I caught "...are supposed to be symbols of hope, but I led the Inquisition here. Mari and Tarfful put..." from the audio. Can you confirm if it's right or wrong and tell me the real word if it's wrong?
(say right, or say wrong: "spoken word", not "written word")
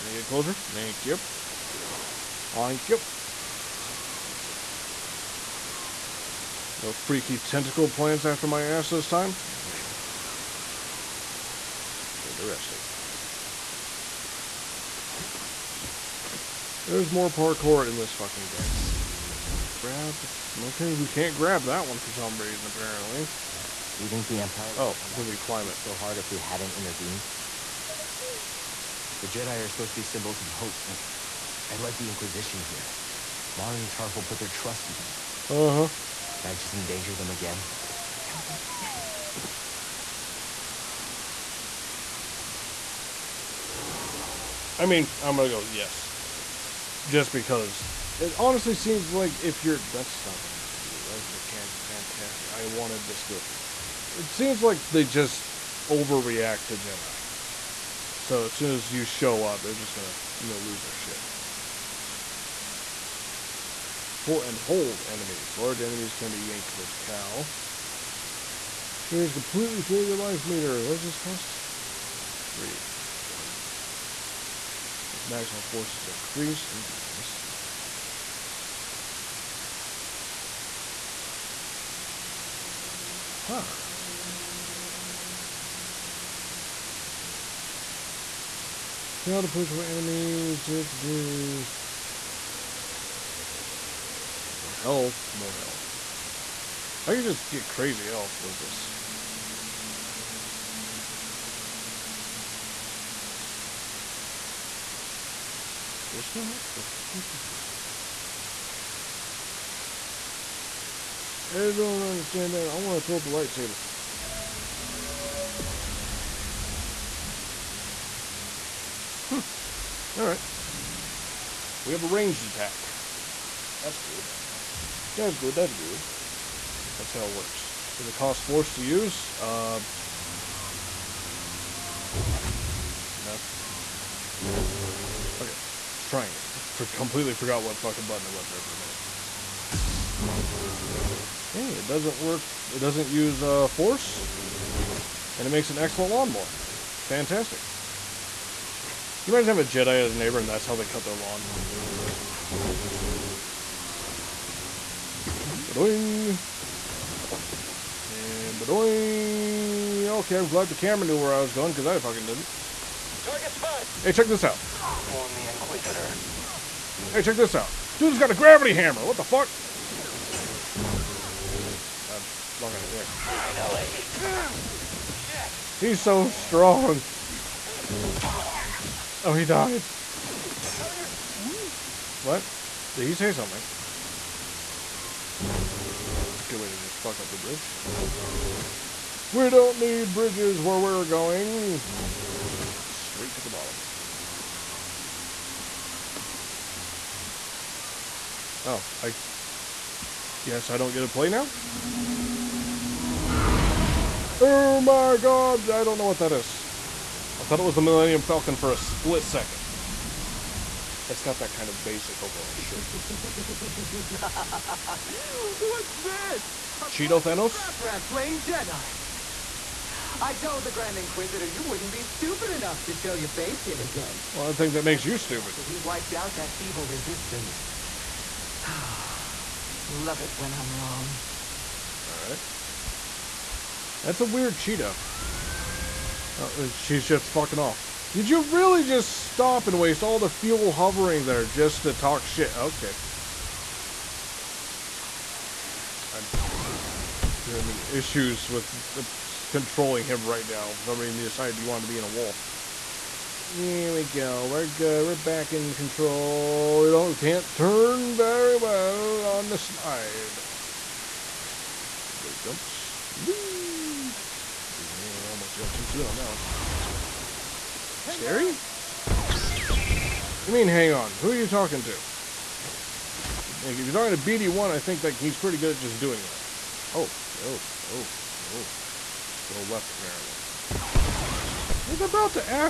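right.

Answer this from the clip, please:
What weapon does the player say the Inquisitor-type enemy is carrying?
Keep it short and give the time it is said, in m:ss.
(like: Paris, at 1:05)
A gravity hammer, at 2:48.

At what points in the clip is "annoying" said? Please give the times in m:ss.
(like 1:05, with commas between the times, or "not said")
not said.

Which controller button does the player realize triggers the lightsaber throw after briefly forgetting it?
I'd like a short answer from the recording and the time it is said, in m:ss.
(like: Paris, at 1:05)
Triangle, at 2:16.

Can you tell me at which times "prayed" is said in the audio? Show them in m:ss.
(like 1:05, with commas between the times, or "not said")
not said.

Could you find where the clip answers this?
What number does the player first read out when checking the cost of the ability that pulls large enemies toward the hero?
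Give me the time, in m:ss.
1:12.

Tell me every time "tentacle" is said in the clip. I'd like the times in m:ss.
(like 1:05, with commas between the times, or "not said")
0:07.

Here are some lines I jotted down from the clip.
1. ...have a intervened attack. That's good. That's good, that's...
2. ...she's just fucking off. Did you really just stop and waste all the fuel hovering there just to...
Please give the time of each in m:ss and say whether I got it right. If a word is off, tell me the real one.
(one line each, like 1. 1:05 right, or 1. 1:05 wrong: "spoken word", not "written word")
1. 2:01 wrong: "ranged", not "intervened"
2. 3:56 right.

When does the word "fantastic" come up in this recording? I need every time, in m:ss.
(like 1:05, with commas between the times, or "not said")
0:51, 2:27.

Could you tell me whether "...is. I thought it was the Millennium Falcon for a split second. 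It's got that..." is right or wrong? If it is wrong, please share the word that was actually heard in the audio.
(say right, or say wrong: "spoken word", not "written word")
right.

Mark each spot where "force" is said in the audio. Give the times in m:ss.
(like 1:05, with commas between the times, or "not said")
1:15, 2:08, 2:23.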